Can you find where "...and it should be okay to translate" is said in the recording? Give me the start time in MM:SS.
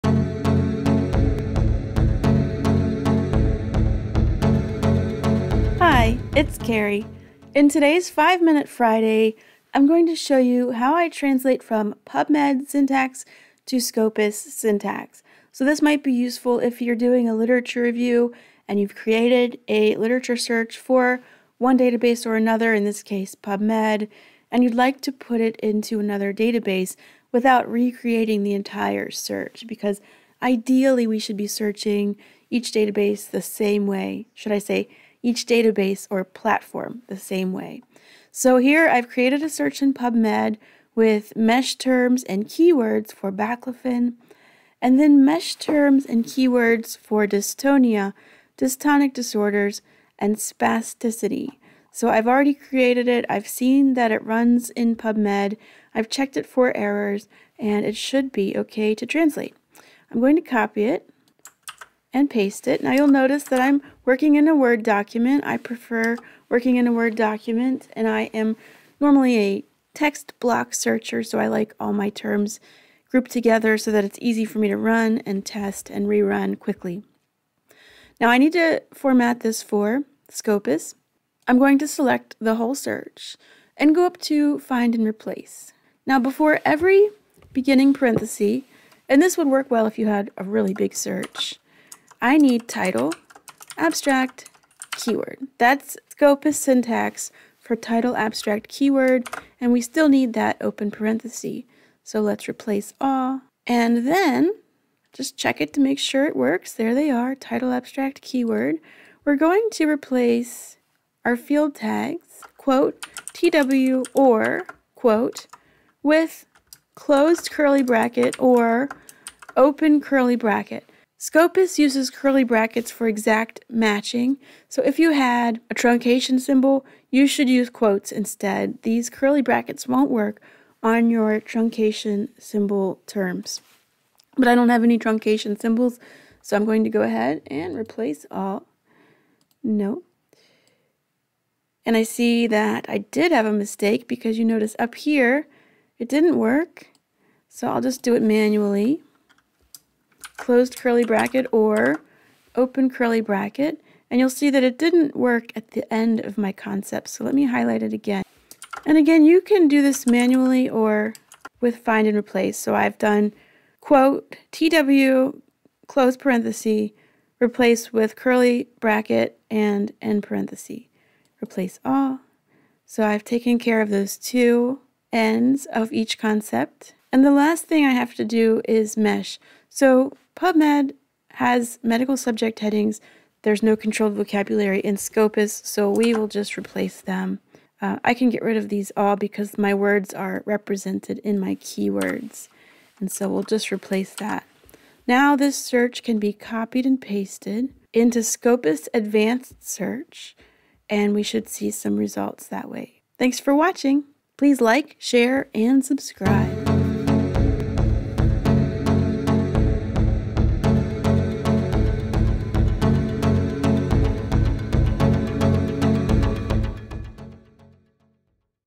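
00:57.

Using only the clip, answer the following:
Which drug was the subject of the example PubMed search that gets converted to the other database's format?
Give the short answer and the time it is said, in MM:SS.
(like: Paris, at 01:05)
Baclofen, at 00:43.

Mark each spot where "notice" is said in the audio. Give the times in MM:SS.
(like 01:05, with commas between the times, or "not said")
01:03, 02:24.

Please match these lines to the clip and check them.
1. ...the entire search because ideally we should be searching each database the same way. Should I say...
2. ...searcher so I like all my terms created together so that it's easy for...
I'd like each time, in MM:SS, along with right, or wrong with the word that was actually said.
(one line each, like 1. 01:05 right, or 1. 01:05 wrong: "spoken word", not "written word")
1. 00:28 right
2. 01:10 wrong: "grouped", not "created".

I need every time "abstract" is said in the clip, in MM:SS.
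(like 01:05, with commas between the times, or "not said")
01:33, 01:38, 01:47.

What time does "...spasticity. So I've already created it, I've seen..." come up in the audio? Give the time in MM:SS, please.
00:50.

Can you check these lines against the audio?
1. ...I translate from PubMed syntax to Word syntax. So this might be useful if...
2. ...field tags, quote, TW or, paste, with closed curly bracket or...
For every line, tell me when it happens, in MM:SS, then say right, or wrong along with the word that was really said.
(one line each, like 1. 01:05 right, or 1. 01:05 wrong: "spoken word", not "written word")
1. 00:10 wrong: "Scopus", not "Word"
2. 01:51 wrong: "quote", not "paste".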